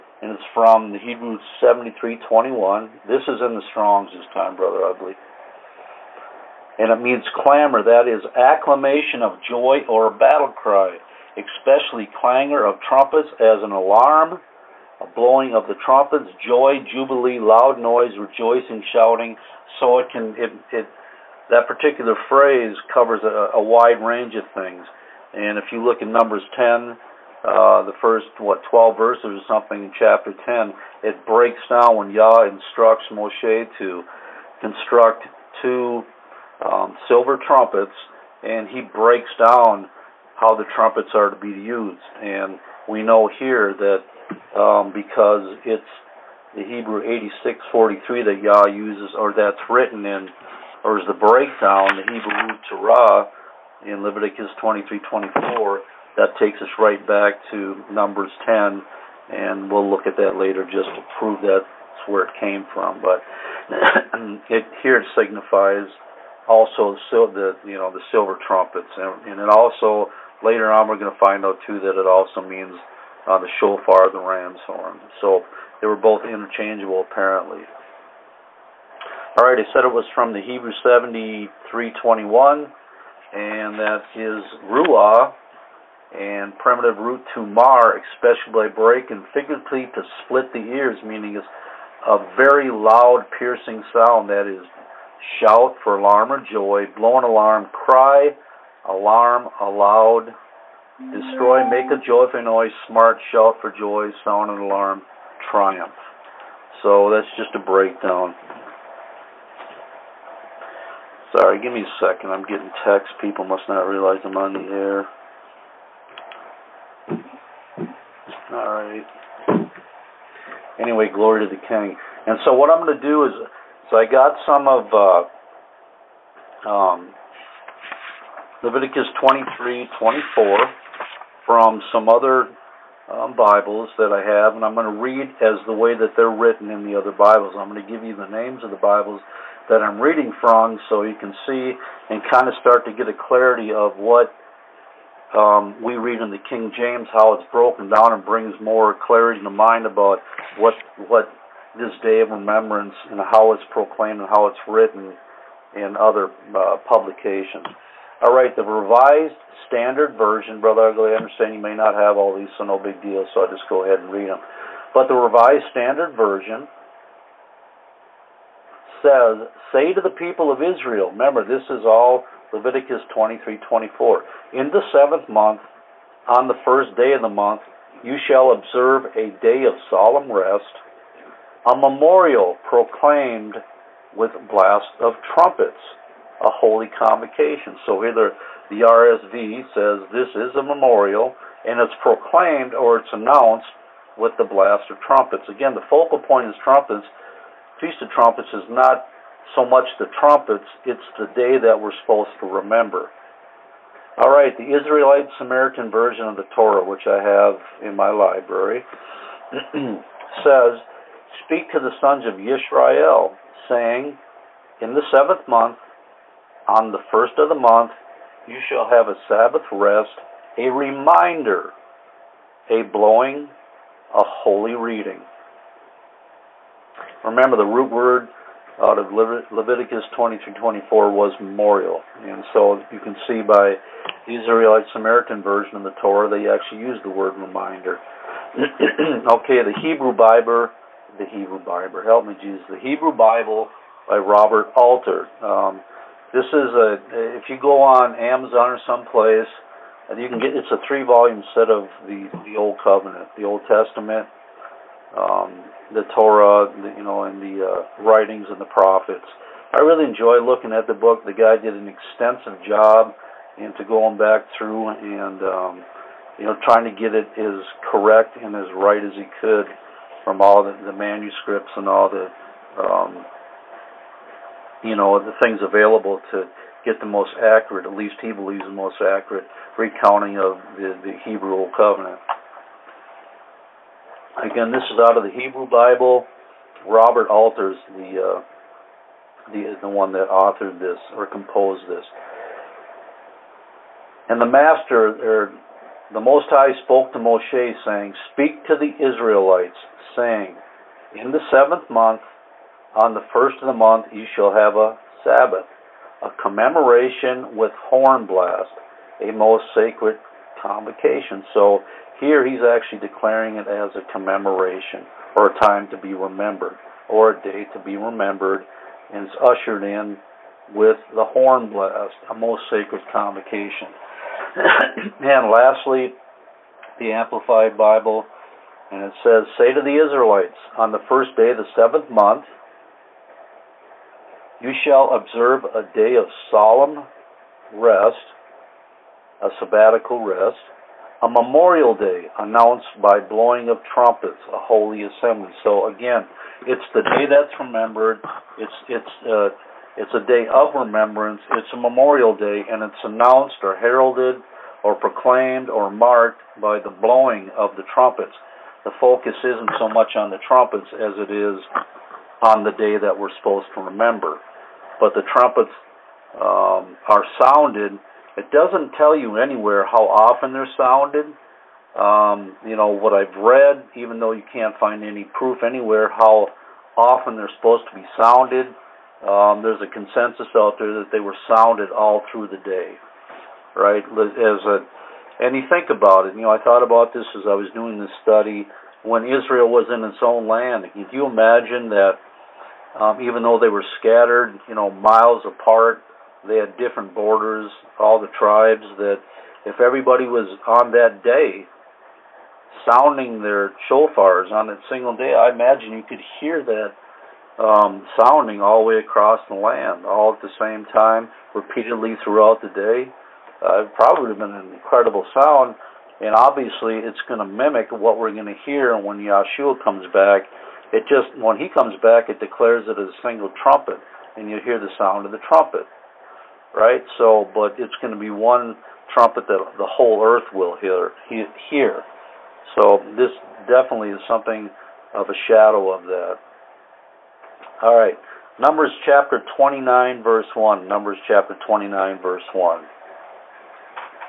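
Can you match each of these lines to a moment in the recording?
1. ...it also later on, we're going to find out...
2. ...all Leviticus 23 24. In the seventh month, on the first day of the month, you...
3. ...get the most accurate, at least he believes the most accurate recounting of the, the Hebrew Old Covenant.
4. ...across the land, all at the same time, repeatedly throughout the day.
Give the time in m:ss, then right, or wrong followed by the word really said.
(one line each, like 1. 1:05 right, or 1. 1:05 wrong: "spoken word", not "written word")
1. 1:09 right
2. 2:51 right
3. 4:36 right
4. 6:48 right.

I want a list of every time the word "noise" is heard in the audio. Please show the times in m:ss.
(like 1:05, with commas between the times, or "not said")
0:17, 1:42.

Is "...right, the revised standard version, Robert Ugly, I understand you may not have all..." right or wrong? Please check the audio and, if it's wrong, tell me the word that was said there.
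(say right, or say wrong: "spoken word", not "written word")
wrong: "Brother", not "Robert".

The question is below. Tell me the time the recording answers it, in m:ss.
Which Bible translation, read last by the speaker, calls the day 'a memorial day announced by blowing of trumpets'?
5:27.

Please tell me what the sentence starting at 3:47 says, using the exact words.
Remember, the root word out of Leviticus 20 24 was memorial.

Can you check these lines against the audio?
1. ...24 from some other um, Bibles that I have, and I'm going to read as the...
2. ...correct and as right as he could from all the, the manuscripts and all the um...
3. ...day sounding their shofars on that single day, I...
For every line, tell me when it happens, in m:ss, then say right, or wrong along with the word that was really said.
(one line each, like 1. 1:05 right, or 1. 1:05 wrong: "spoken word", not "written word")
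1. 2:09 right
2. 4:27 right
3. 6:41 right.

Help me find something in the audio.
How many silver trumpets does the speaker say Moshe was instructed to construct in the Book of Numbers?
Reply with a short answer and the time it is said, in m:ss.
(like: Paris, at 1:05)
2, at 0:35.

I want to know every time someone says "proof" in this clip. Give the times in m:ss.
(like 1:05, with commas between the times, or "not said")
6:15.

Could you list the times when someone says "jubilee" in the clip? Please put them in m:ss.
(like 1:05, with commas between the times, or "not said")
0:16.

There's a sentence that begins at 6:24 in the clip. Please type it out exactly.
As a, and you think about it.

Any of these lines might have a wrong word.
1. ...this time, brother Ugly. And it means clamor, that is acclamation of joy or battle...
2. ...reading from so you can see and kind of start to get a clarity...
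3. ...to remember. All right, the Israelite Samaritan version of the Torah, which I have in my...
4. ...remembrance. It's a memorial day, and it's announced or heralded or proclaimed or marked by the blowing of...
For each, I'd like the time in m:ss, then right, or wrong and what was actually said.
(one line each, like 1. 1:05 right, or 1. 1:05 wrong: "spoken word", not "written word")
1. 0:04 right
2. 2:19 right
3. 3:22 right
4. 5:50 right.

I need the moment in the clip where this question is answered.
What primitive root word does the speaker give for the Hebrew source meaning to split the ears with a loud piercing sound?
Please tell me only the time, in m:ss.
1:24.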